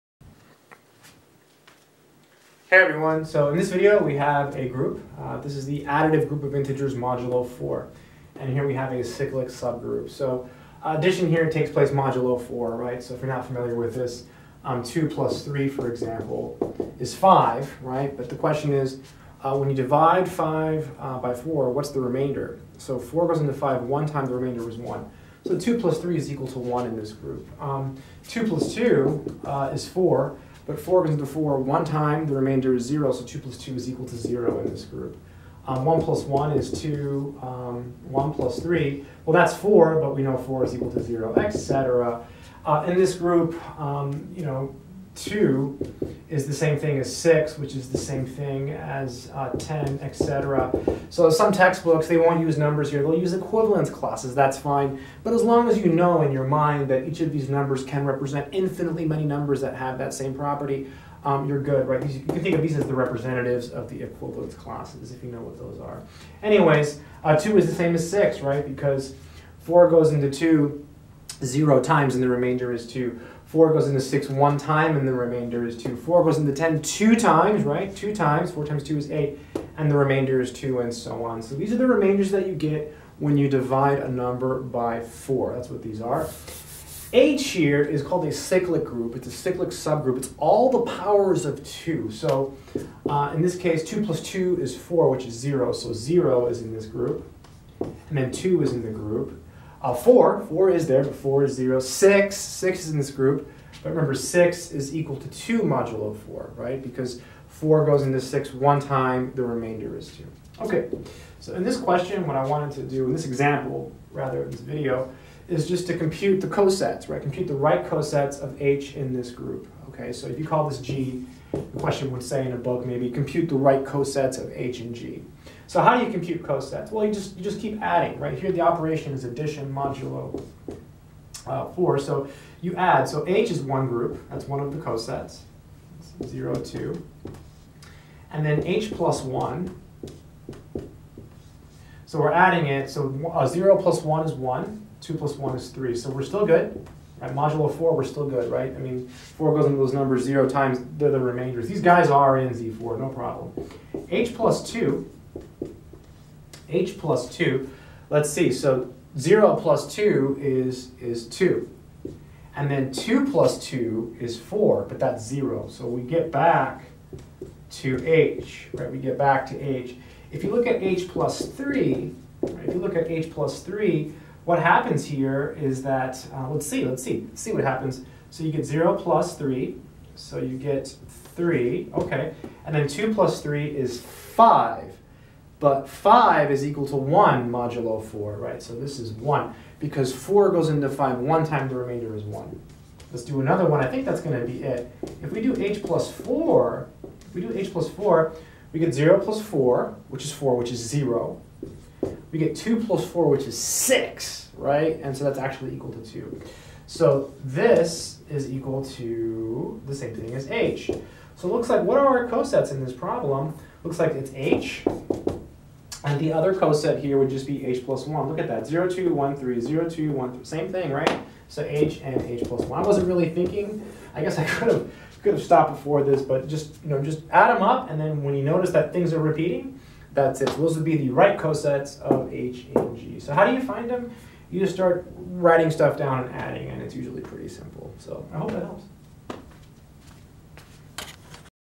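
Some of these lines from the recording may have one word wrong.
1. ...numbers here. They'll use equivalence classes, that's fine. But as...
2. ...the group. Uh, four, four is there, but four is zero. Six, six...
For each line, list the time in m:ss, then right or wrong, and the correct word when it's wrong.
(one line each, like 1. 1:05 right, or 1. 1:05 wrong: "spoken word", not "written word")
1. 0:52 right
2. 1:38 right.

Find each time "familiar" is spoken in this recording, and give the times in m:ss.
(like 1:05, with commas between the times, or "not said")
0:13.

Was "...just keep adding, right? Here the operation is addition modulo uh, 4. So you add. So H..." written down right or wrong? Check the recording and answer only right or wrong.
right.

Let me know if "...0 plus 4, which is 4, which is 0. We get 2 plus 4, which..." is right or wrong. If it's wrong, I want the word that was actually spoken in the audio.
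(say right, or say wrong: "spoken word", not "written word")
right.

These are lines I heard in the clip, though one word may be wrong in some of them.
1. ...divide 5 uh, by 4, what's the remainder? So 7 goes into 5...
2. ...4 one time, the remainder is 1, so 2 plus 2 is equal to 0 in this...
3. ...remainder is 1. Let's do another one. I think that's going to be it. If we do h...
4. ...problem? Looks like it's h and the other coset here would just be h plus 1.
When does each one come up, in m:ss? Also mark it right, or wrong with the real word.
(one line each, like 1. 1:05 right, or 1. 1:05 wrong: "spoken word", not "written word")
1. 0:19 wrong: "4", not "7"
2. 0:31 wrong: "0", not "1"
3. 3:11 right
4. 3:32 right.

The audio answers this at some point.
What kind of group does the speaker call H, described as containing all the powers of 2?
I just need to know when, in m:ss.
1:28.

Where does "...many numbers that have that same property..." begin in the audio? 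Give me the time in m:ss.
0:59.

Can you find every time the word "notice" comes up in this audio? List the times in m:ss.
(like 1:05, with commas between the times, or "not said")
3:48.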